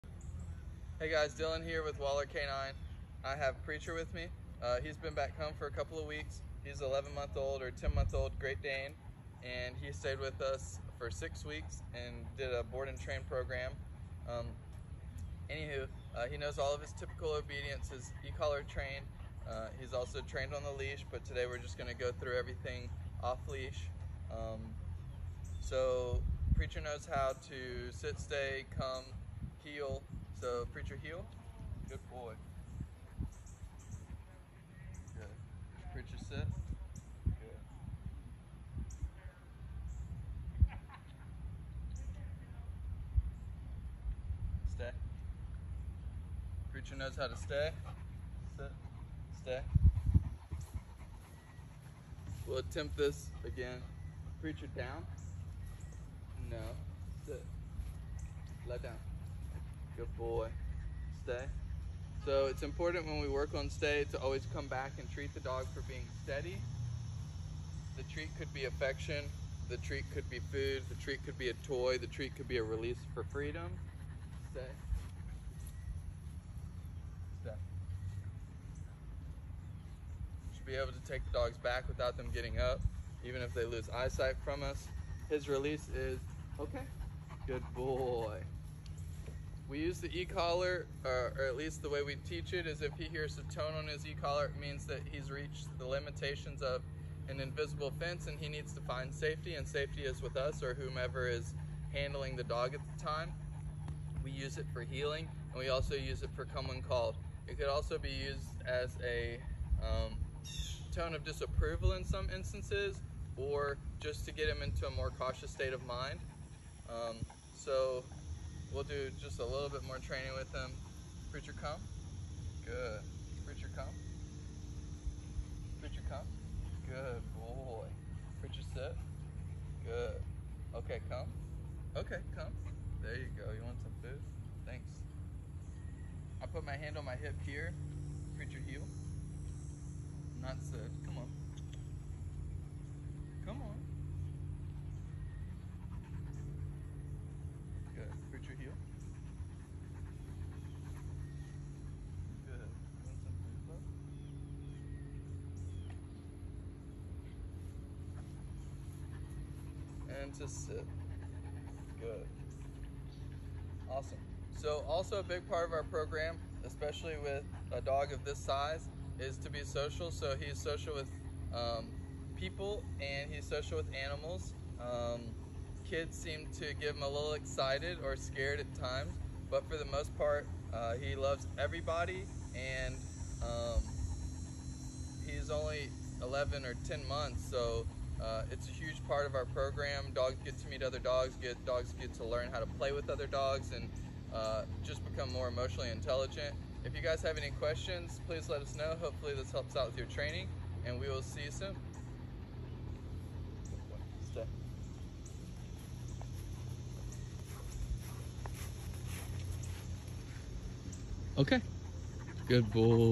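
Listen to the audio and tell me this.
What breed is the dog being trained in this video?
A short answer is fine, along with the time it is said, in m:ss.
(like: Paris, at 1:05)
Great Dane, at 0:08.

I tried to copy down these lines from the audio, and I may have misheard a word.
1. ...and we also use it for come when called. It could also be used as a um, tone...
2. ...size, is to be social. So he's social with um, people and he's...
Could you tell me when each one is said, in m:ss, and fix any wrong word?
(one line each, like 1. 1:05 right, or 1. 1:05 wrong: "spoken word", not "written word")
1. 1:45 right
2. 2:48 right.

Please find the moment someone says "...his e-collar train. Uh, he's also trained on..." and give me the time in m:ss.
0:17.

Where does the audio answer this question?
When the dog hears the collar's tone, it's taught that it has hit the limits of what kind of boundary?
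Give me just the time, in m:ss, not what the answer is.
1:37.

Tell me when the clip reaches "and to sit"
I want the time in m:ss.
2:40.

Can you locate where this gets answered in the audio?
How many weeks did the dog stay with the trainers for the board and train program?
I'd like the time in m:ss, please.
0:11.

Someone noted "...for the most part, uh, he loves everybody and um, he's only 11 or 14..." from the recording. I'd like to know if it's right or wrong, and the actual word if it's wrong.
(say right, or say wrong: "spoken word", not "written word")
wrong: "10", not "14".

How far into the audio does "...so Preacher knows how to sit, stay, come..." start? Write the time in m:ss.
0:25.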